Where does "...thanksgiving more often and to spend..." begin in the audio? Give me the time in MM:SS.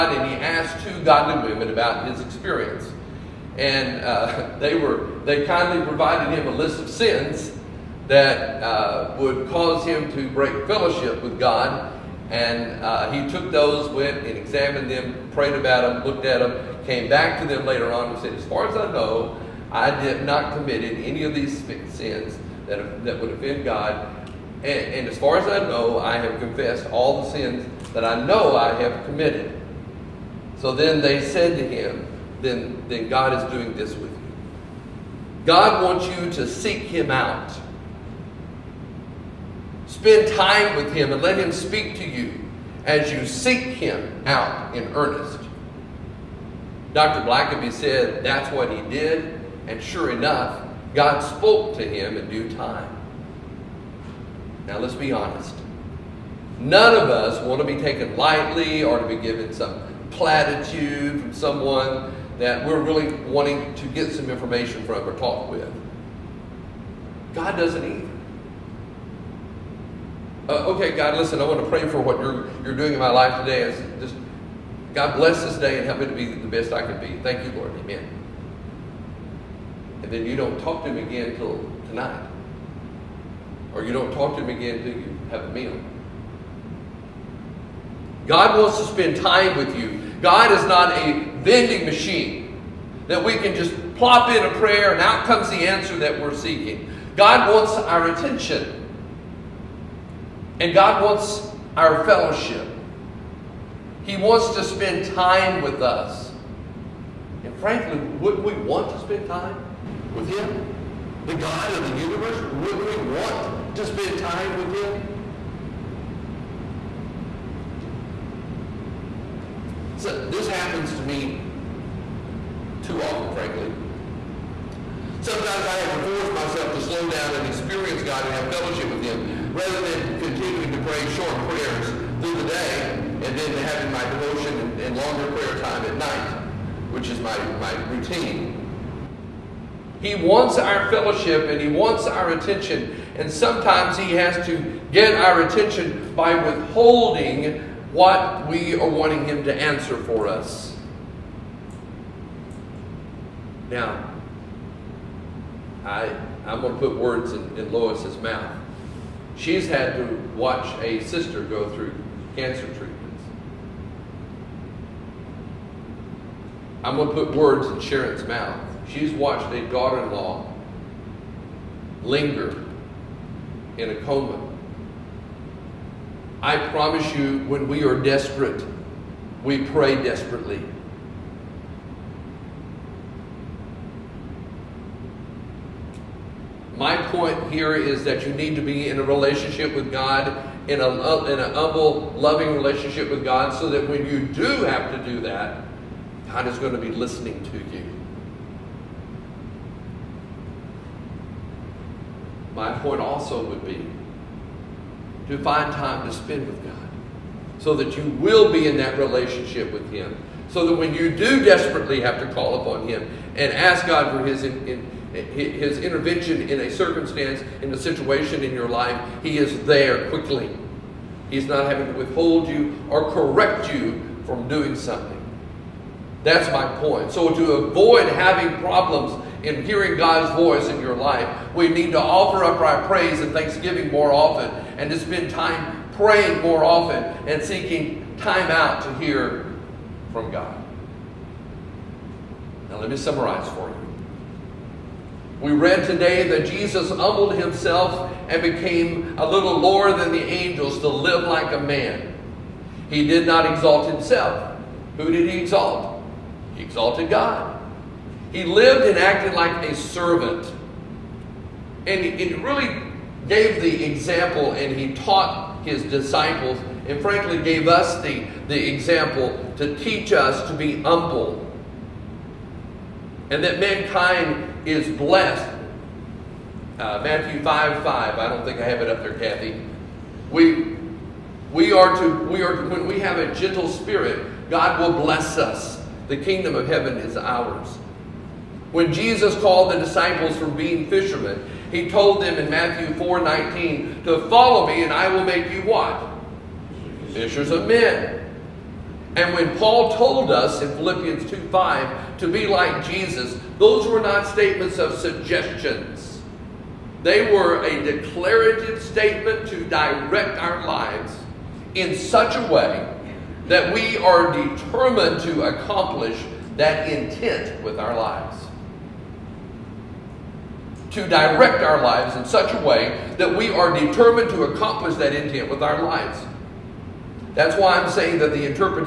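03:53.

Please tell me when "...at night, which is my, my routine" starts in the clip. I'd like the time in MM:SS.
02:15.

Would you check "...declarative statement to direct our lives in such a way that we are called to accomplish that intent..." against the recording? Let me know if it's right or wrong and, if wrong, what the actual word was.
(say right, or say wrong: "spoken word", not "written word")
wrong: "determined", not "called".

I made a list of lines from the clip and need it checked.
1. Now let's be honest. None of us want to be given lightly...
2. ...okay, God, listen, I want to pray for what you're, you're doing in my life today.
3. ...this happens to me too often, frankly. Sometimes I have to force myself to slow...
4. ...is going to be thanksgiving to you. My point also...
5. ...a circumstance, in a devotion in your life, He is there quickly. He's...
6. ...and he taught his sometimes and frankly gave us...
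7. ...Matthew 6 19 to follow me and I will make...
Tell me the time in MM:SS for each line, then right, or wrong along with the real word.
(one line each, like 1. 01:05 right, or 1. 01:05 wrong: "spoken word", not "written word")
1. 00:54 wrong: "taken", not "given"
2. 01:10 right
3. 02:00 right
4. 03:16 wrong: "listening", not "thanksgiving"
5. 03:36 wrong: "situation", not "devotion"
6. 04:24 wrong: "disciples", not "sometimes"
7. 04:52 wrong: "4", not "6".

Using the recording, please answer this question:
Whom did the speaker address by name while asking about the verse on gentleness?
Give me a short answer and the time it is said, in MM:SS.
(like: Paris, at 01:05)
Kathy, at 04:39.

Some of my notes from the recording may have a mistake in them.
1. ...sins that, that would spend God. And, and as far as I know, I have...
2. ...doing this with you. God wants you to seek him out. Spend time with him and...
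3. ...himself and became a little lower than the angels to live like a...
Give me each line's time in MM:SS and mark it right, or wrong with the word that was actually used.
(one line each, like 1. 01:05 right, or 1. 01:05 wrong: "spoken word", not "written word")
1. 00:21 wrong: "offend", not "spend"
2. 00:33 right
3. 04:07 right.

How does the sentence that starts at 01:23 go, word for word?
Or you don't talk to him again till you have a meal.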